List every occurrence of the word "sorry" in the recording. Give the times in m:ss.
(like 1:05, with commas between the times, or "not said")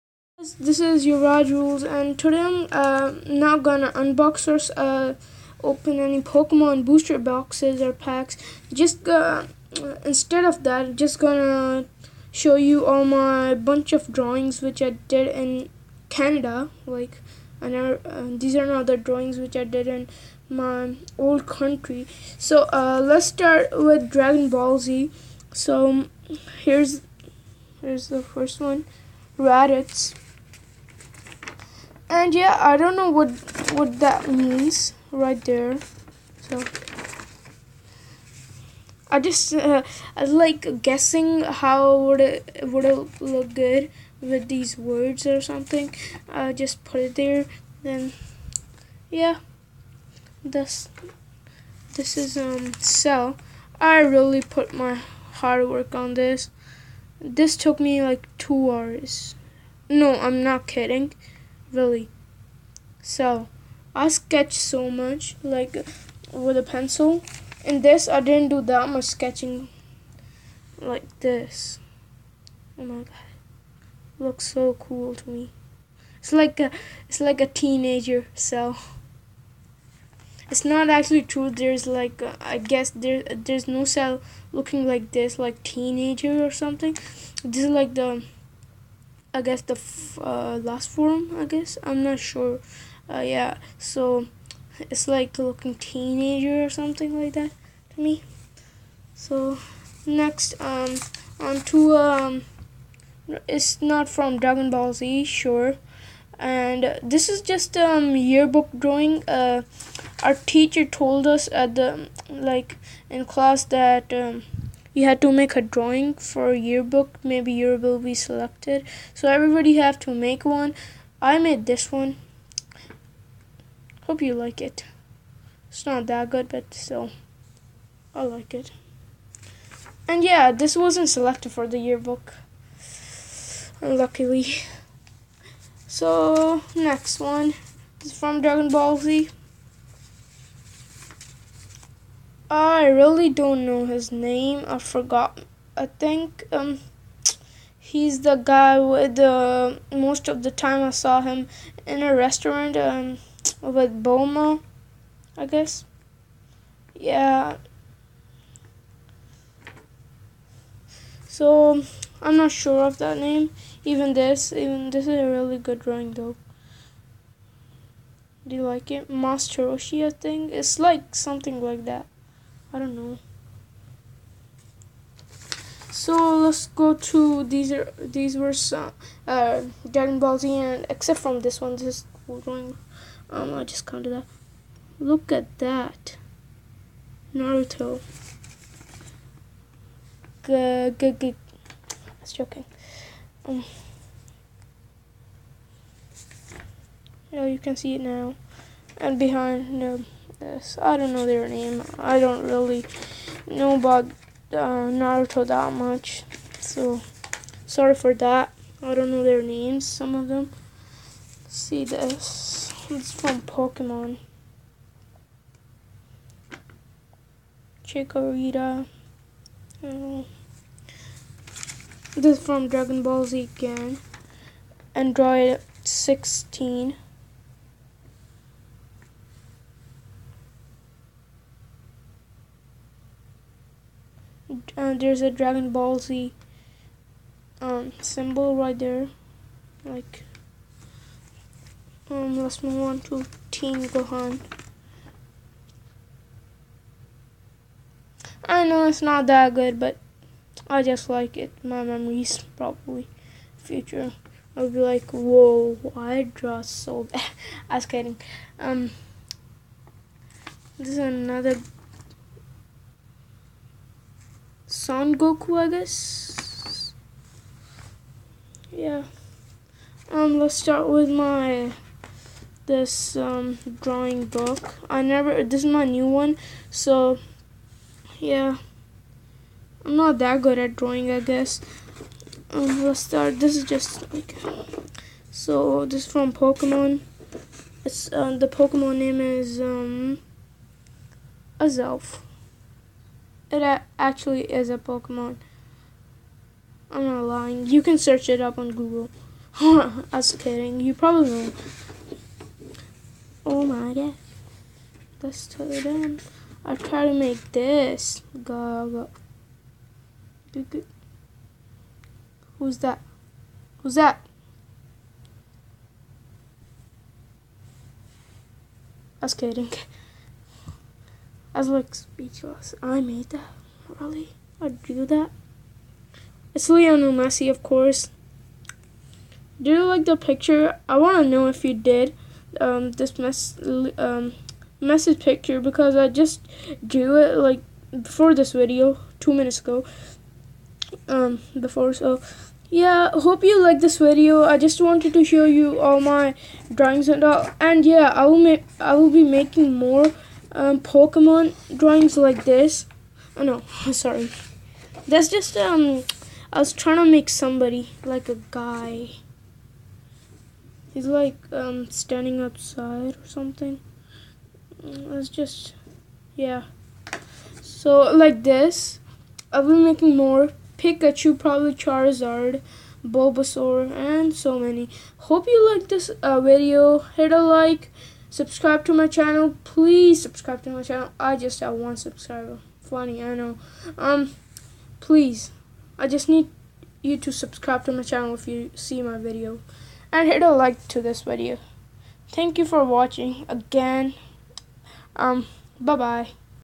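3:27, 5:53.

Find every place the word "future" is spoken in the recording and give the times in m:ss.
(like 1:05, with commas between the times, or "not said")
4:13.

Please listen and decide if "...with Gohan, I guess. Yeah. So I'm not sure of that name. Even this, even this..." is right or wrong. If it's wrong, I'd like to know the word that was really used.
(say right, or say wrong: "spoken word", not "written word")
wrong: "Bulma", not "Gohan".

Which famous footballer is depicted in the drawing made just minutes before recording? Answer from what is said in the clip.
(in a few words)
Lionel Messi.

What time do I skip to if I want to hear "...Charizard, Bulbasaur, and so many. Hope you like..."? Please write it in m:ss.
6:11.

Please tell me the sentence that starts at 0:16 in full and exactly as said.
Like, and uh, these are not the drawings which I did in my old country.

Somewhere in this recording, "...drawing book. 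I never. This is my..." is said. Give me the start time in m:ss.
4:33.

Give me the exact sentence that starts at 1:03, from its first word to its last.
So I sketch so much like with a pencil.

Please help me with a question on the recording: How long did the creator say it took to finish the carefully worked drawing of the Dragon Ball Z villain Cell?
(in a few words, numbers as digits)
2 hours.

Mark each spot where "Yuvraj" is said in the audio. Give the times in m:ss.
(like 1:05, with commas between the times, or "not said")
0:01.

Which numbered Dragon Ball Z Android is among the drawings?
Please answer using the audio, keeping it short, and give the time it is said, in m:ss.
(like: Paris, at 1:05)
Android 16, at 3:44.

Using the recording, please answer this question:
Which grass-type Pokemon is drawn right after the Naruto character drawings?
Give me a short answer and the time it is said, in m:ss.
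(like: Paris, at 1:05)
Chikorita, at 3:37.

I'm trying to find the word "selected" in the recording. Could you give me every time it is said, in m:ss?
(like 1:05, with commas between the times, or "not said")
1:58, 2:11.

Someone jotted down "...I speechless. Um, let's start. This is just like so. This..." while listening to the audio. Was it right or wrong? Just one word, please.
wrong.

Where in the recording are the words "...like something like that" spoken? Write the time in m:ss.
2:50.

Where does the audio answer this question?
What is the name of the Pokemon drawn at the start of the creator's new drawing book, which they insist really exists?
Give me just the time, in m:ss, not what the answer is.
4:51.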